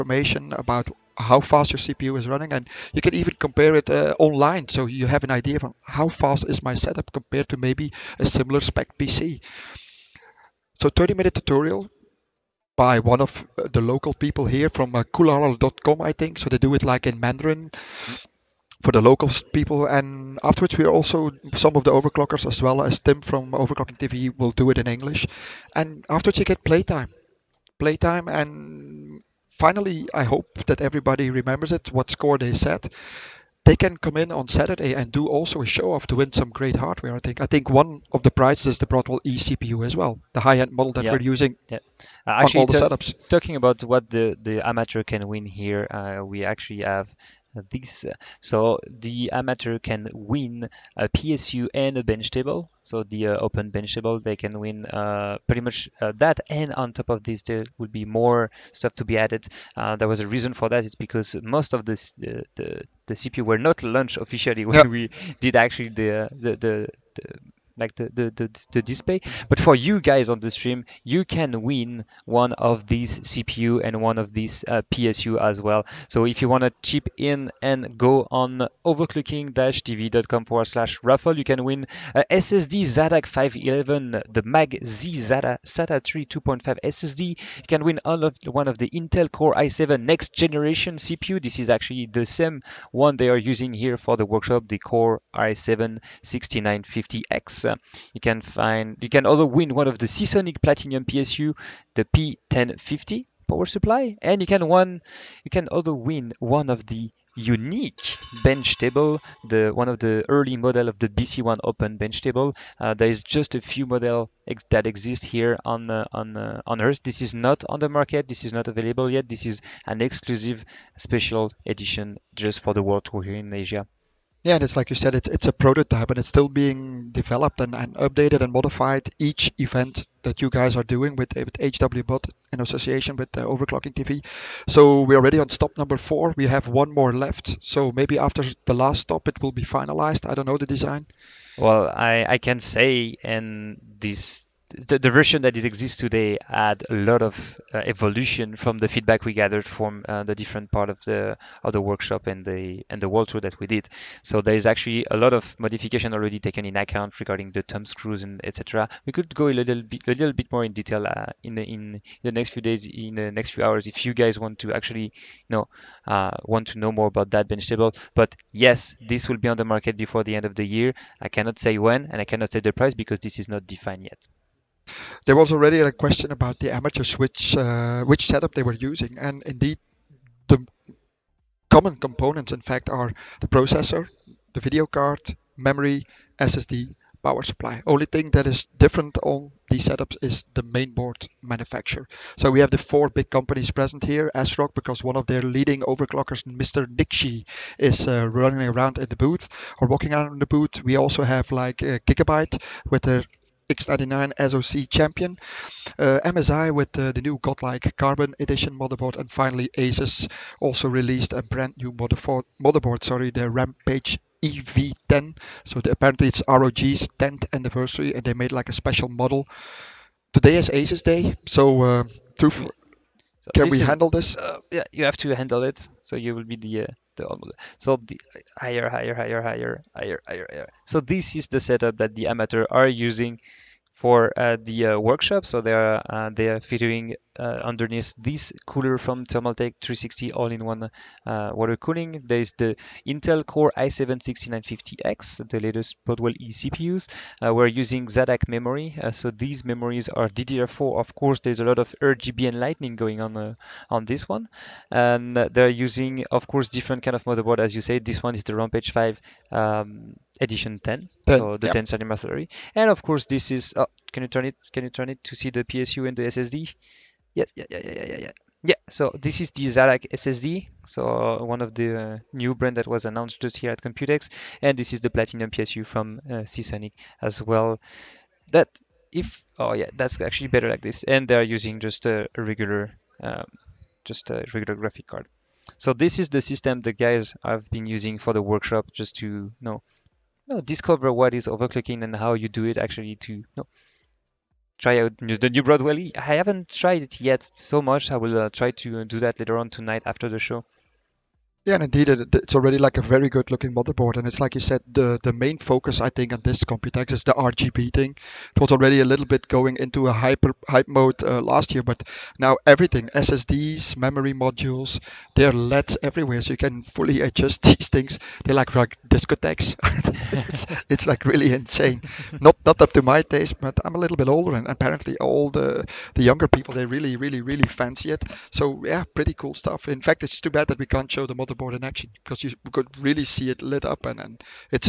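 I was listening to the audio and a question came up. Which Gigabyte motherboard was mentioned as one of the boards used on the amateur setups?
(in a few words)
X99 SoC Champion.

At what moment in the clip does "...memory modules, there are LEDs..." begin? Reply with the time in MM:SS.
05:13.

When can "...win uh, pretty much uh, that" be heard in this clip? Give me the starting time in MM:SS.
00:54.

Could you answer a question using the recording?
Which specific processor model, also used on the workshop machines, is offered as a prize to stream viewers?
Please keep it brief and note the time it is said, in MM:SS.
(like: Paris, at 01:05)
Core i7 6950X, at 01:34.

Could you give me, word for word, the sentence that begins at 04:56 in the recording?
I haven't tried it yet so much.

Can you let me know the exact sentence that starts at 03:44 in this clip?
Uh, yeah, you have to handle it.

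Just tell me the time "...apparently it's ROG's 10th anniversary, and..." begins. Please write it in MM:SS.
03:35.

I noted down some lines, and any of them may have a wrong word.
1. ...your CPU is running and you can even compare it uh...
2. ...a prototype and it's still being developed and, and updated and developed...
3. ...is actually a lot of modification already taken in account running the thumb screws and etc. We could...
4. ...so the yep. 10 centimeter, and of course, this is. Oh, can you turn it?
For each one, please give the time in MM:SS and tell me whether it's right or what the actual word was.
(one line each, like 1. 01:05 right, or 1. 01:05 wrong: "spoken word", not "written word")
1. 00:01 right
2. 02:05 wrong: "modified", not "developed"
3. 02:34 wrong: "regarding", not "running"
4. 04:21 right.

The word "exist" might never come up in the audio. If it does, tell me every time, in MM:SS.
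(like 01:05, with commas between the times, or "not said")
01:54, 02:25.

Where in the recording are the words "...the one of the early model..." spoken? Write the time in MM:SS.
01:49.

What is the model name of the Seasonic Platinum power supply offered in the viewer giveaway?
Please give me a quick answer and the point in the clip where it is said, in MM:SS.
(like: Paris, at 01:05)
P1050, at 01:42.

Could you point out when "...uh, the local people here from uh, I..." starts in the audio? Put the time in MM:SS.
00:13.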